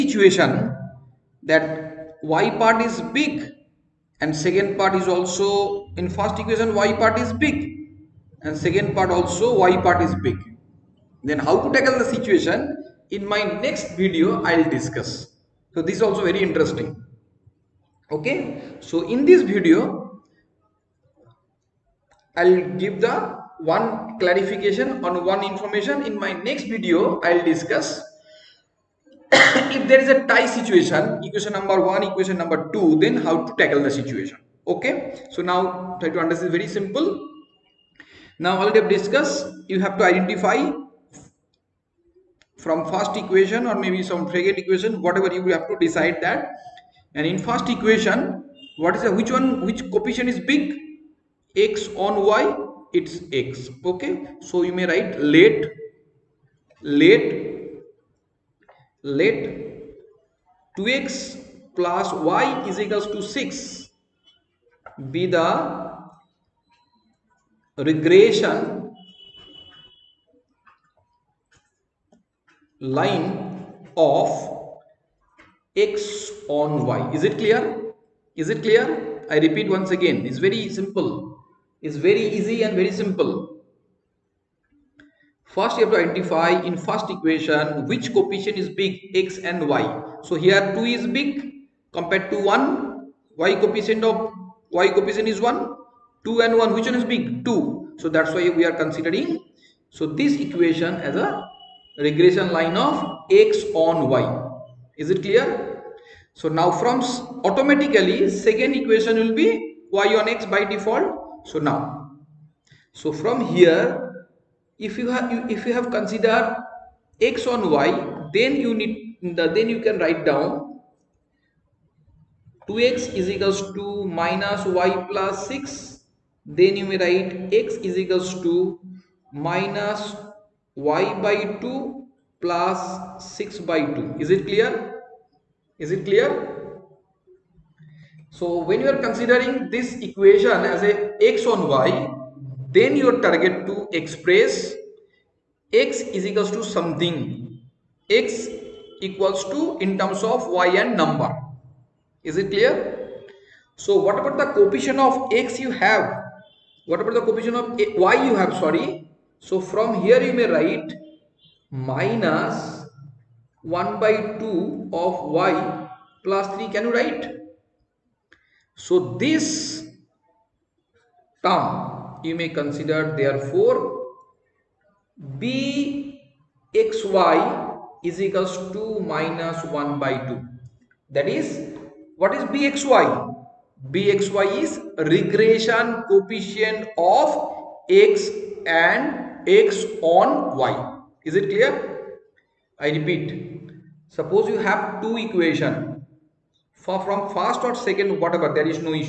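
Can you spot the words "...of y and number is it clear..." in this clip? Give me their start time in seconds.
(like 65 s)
150 s.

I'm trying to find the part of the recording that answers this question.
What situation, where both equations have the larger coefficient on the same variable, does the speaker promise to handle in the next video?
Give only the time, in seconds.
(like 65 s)
30 s.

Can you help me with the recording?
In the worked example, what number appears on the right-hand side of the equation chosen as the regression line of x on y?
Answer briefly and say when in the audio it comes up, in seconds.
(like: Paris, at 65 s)
6, at 60 s.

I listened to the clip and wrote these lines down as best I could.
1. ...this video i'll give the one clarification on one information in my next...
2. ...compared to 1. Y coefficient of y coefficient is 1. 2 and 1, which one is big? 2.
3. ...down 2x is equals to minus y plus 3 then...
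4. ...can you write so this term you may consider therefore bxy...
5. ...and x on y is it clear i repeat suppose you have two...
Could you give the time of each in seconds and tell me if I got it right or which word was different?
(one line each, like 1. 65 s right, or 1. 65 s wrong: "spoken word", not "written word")
1. 19 s right
2. 91 s right
3. 120 s wrong: "6", not "3"
4. 166 s right
5. 188 s right.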